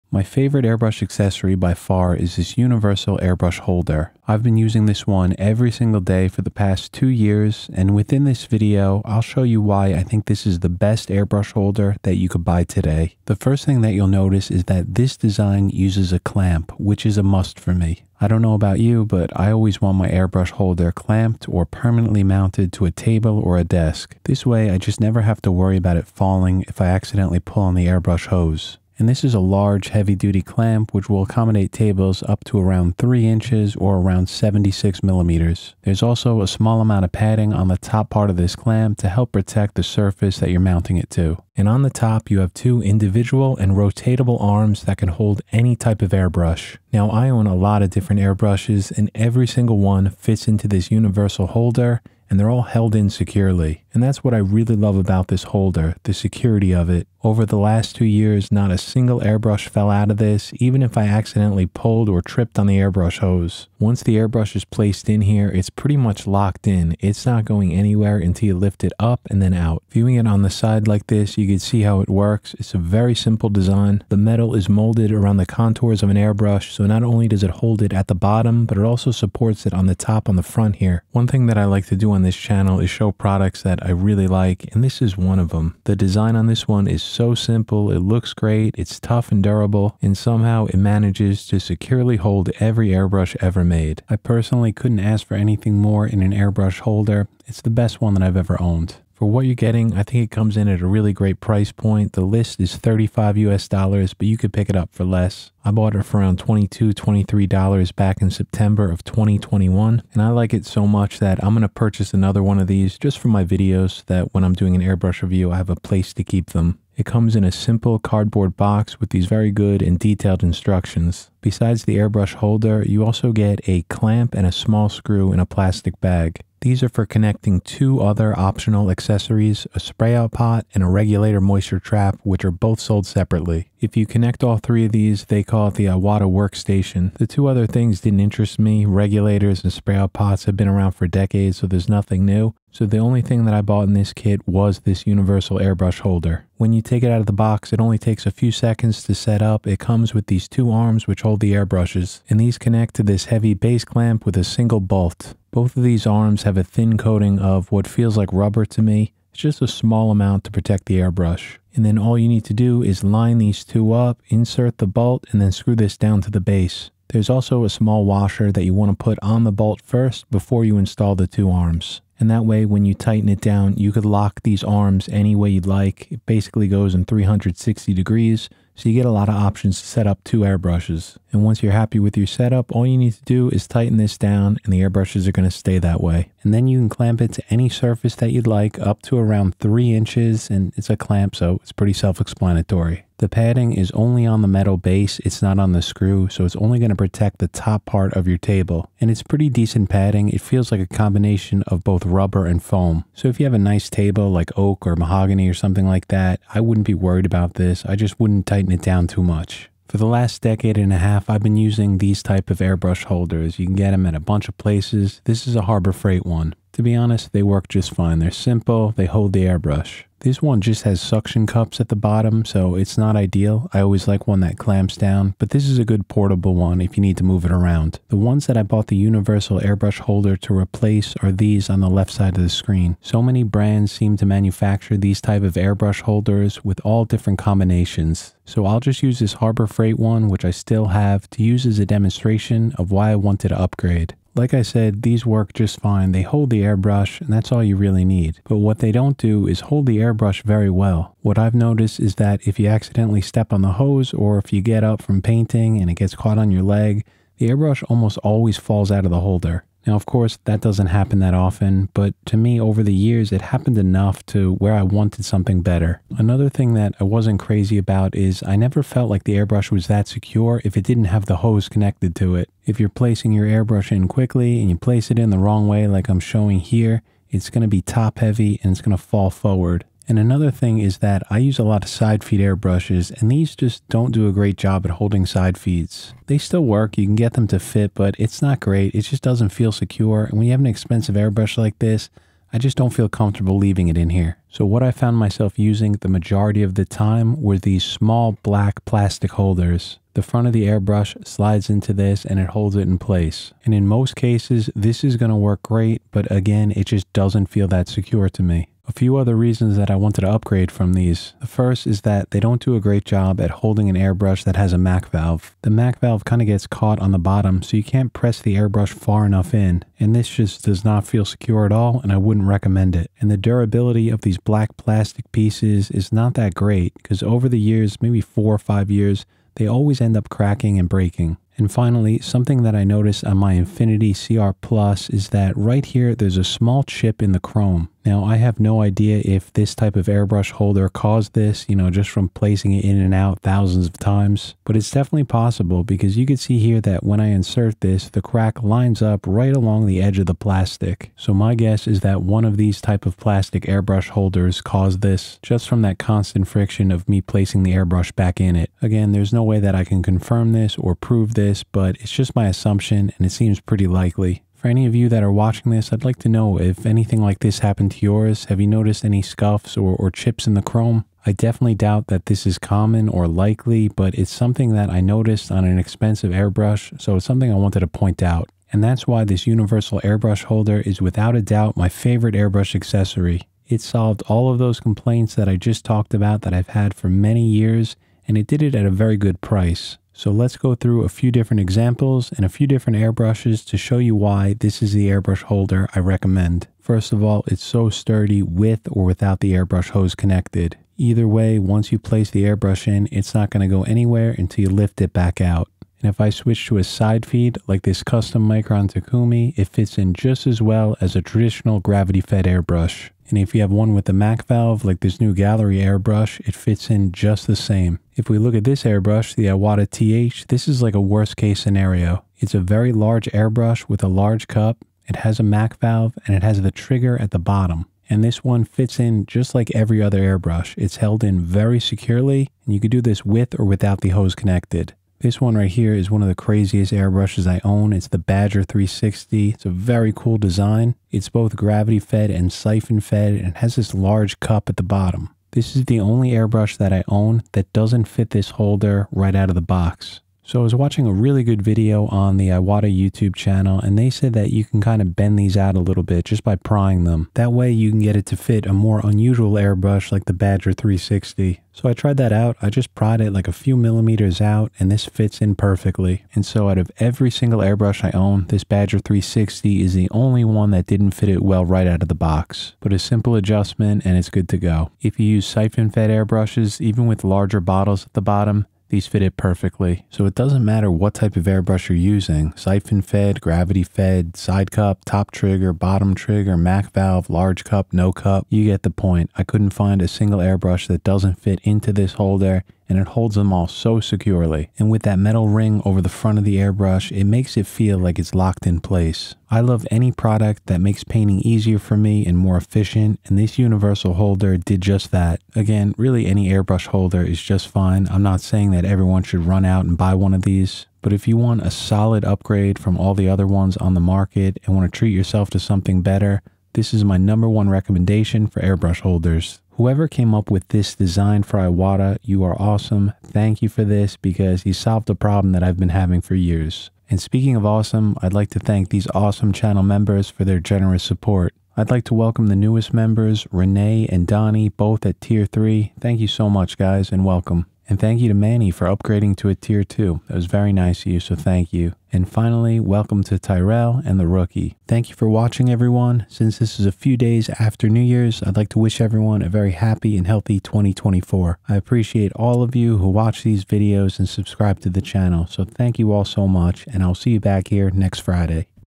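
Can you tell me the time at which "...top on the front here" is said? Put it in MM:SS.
01:19.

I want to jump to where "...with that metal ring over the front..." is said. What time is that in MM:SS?
08:14.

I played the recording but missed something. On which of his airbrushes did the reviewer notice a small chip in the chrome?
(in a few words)
Infinity CR Plus.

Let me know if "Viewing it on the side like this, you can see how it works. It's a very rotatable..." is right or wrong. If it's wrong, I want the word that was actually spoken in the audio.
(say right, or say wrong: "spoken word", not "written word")
wrong: "simple", not "rotatable".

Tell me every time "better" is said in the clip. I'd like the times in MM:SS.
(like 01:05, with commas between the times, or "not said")
04:25, 08:36.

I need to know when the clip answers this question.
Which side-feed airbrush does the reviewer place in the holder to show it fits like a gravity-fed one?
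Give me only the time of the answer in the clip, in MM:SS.
06:48.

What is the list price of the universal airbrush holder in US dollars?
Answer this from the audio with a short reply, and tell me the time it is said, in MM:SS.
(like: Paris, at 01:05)
$35, at 01:42.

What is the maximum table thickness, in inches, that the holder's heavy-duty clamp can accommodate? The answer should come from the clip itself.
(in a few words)
3 inches.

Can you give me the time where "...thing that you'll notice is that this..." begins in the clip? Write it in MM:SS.
00:13.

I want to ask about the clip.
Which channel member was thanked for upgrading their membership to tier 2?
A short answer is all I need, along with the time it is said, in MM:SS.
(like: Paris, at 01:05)
Manny, at 08:58.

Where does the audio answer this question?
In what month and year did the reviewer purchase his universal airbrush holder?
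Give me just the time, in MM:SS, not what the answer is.
01:48.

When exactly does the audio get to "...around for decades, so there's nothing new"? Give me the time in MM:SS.
02:20.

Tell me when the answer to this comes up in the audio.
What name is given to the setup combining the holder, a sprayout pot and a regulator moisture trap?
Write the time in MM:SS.
02:15.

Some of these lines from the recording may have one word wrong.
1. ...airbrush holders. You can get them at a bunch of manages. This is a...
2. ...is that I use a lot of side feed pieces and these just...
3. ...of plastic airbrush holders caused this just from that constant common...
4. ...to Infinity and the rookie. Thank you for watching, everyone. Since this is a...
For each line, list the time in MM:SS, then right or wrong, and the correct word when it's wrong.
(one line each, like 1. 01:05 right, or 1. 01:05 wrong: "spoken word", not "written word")
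1. 03:32 wrong: "places", not "manages"
2. 04:40 wrong: "airbrushes", not "pieces"
3. 05:53 wrong: "friction", not "common"
4. 09:03 wrong: "Tyrell", not "Infinity".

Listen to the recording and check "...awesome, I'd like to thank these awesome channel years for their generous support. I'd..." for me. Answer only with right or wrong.
wrong.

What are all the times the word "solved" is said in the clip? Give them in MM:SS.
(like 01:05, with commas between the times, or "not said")
06:23, 08:44.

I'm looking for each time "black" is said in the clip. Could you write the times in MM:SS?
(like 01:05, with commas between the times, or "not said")
04:58, 05:24.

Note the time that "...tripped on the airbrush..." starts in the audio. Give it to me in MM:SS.
01:02.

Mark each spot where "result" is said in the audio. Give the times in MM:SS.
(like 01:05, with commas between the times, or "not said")
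not said.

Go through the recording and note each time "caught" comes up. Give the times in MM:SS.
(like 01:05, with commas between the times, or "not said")
04:16, 05:16.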